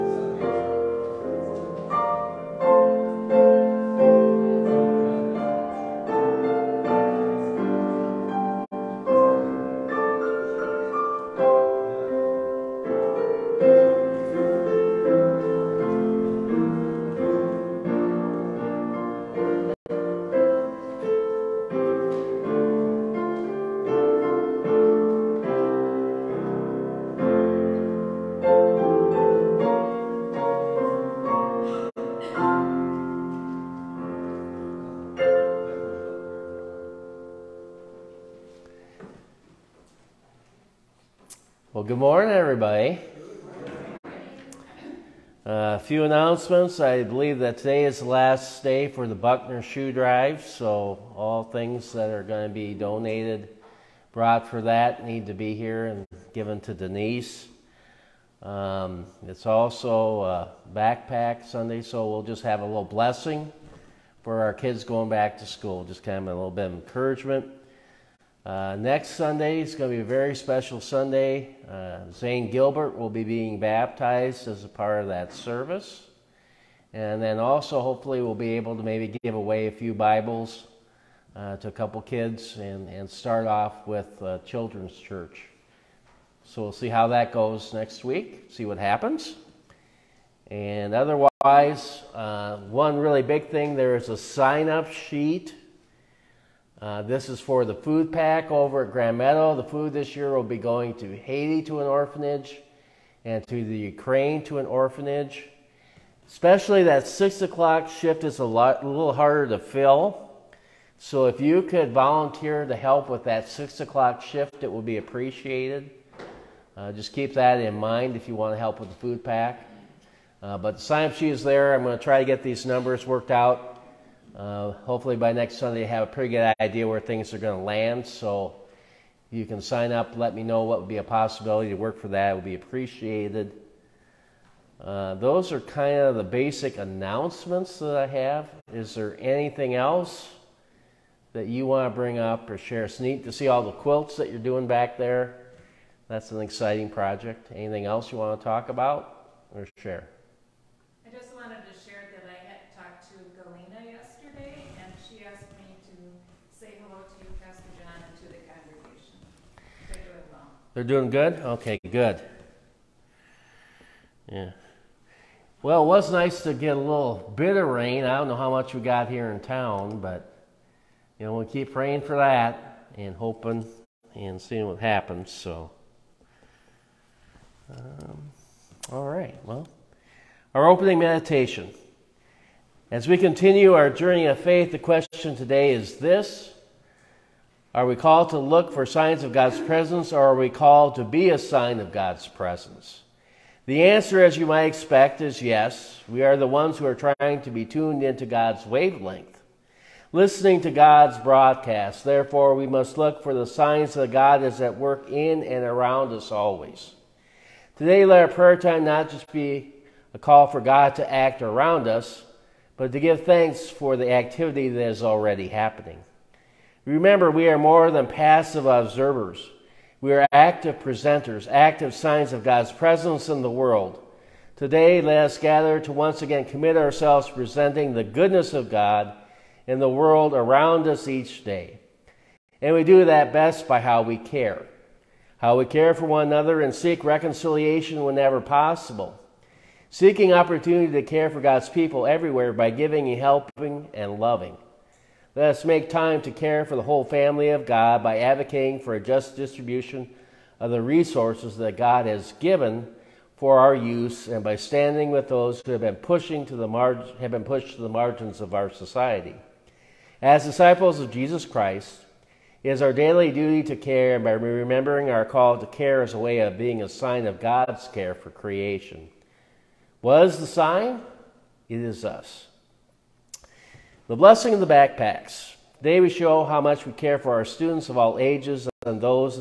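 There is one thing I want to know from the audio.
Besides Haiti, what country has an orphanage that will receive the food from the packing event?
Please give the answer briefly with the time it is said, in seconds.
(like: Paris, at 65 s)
Ukraine, at 103 s.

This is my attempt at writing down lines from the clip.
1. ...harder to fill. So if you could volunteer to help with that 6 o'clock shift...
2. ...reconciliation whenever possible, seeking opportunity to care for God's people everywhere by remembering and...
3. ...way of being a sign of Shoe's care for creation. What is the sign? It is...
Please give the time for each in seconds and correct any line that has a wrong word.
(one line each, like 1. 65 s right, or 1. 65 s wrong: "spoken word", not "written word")
1. 109 s right
2. 237 s wrong: "giving", not "remembering"
3. 266 s wrong: "God", not "Shoe".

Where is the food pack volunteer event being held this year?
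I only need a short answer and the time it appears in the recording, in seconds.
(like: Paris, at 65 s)
Grand Meadow, at 98 s.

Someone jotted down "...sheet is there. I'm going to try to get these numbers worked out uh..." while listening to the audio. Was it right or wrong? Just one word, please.
right.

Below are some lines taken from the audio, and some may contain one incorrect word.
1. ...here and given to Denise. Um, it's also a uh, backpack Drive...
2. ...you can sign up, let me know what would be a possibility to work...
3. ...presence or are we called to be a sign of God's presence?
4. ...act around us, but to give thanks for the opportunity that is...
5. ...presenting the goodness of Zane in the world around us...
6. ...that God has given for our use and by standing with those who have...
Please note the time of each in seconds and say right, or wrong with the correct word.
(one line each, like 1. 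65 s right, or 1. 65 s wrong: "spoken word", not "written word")
1. 55 s wrong: "Sunday", not "Drive"
2. 129 s right
3. 189 s right
4. 211 s wrong: "activity", not "opportunity"
5. 227 s wrong: "God", not "Zane"
6. 251 s right.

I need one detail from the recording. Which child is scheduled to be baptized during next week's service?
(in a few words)
Zane Gilbert.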